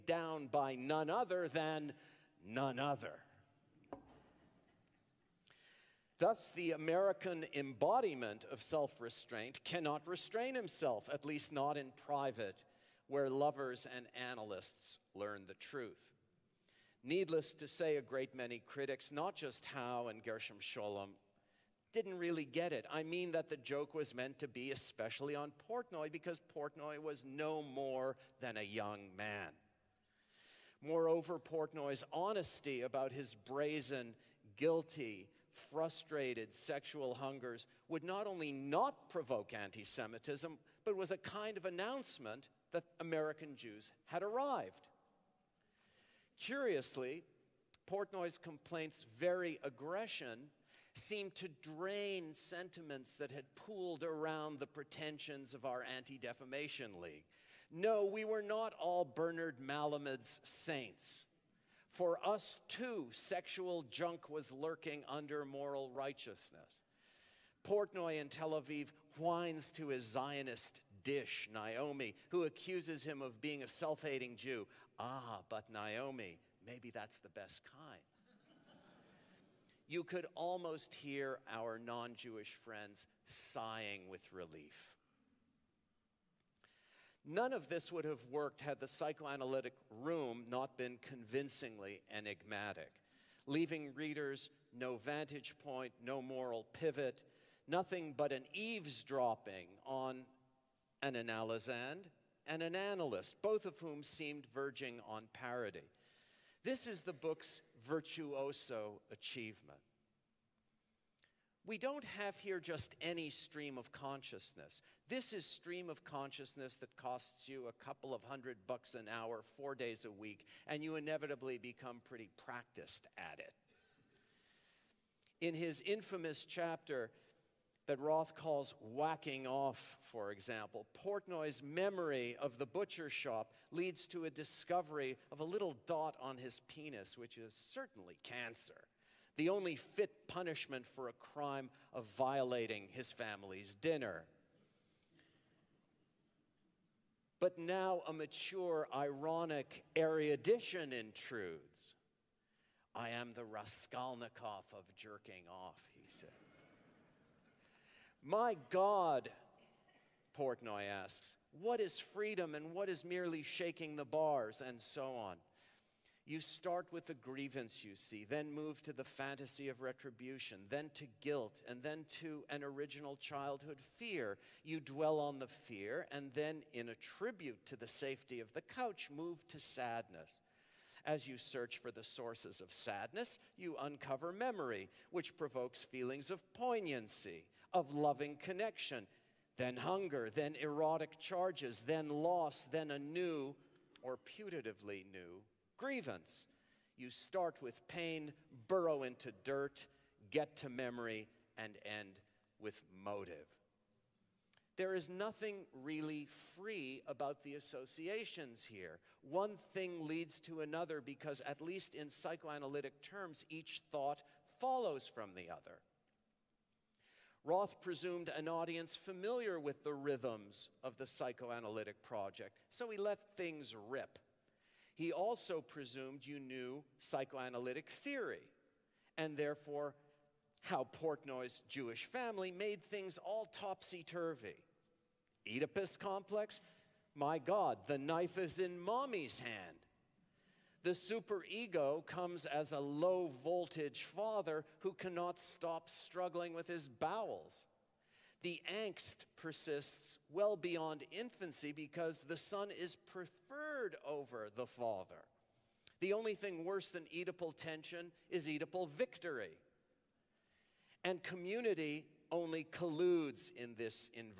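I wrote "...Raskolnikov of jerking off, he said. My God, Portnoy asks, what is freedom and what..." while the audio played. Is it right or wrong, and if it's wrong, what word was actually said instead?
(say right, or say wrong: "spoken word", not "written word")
right.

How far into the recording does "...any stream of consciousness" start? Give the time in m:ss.
1:53.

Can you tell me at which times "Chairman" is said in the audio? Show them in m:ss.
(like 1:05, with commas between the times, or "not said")
not said.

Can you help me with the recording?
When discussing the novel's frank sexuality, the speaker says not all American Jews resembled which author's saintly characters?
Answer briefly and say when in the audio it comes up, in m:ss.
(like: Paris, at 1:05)
Bernard Malamud, at 0:59.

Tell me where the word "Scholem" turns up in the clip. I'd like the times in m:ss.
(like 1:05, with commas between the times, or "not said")
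0:20.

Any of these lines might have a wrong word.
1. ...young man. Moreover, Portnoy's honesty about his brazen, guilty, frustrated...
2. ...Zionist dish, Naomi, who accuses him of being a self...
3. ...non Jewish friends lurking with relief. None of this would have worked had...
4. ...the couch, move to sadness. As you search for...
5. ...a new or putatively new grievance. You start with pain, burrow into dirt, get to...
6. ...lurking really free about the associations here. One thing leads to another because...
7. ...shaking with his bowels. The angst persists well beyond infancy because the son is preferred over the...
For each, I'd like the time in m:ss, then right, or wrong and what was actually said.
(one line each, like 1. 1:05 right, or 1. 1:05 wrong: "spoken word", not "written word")
1. 0:28 right
2. 1:10 right
3. 1:21 wrong: "sighing", not "lurking"
4. 2:58 right
5. 3:12 right
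6. 3:25 wrong: "nothing", not "lurking"
7. 4:05 wrong: "struggling", not "shaking".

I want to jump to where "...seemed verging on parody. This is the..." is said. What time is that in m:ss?
1:44.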